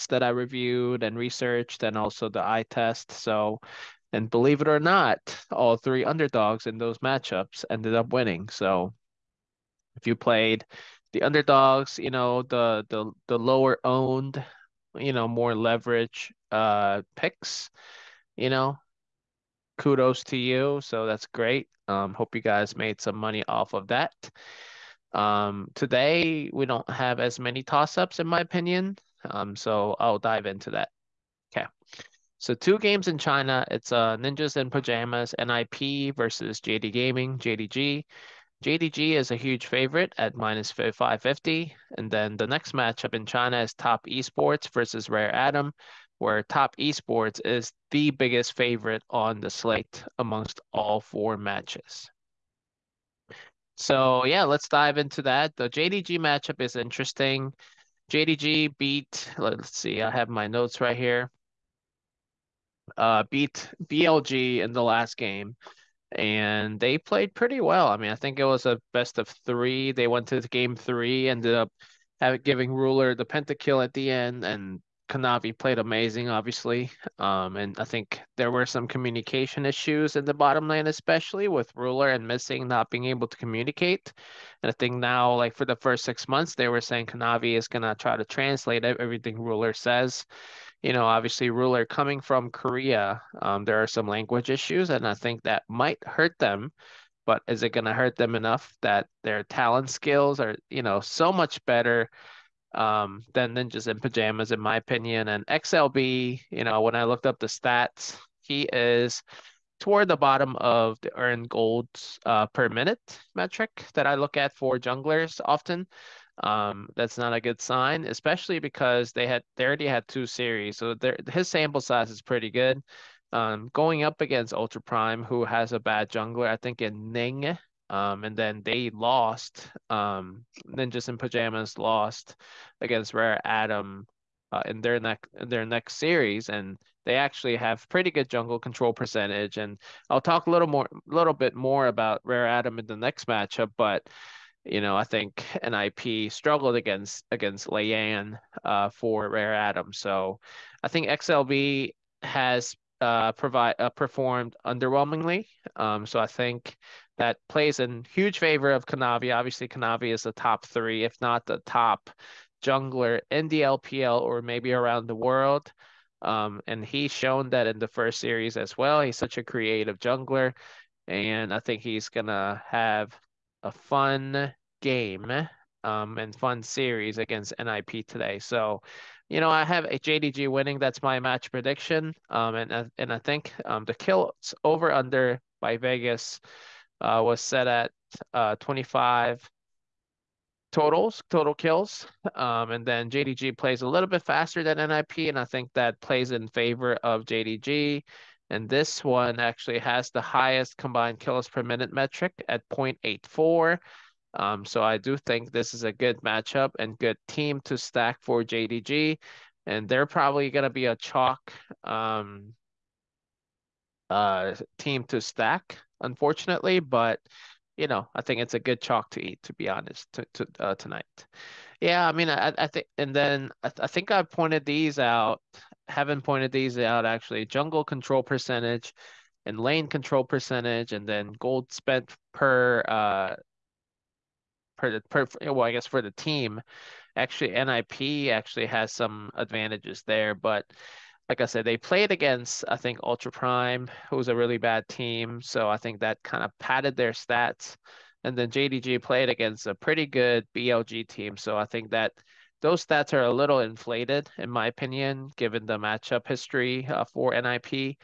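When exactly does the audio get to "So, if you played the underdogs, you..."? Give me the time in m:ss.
0:08.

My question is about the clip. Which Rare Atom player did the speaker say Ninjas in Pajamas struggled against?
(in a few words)
Leyan.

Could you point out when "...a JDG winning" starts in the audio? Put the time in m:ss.
2:59.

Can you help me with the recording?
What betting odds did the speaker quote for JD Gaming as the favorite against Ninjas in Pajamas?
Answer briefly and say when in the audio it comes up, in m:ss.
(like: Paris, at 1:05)
-550, at 0:40.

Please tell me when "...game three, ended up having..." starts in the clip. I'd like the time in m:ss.
1:10.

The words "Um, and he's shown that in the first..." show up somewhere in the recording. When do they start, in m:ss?
2:46.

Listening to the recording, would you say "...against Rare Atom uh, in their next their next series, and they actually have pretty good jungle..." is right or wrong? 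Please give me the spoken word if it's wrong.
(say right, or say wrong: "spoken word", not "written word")
right.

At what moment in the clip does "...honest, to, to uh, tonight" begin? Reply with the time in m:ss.
3:39.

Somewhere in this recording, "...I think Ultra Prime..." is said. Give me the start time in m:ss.
4:02.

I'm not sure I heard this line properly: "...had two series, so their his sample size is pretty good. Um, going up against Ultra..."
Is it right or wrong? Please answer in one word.
right.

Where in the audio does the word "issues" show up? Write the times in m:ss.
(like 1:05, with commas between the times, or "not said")
1:19, 1:34.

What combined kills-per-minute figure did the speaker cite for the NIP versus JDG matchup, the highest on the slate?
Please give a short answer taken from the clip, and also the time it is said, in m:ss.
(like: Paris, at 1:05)
0.84, at 3:22.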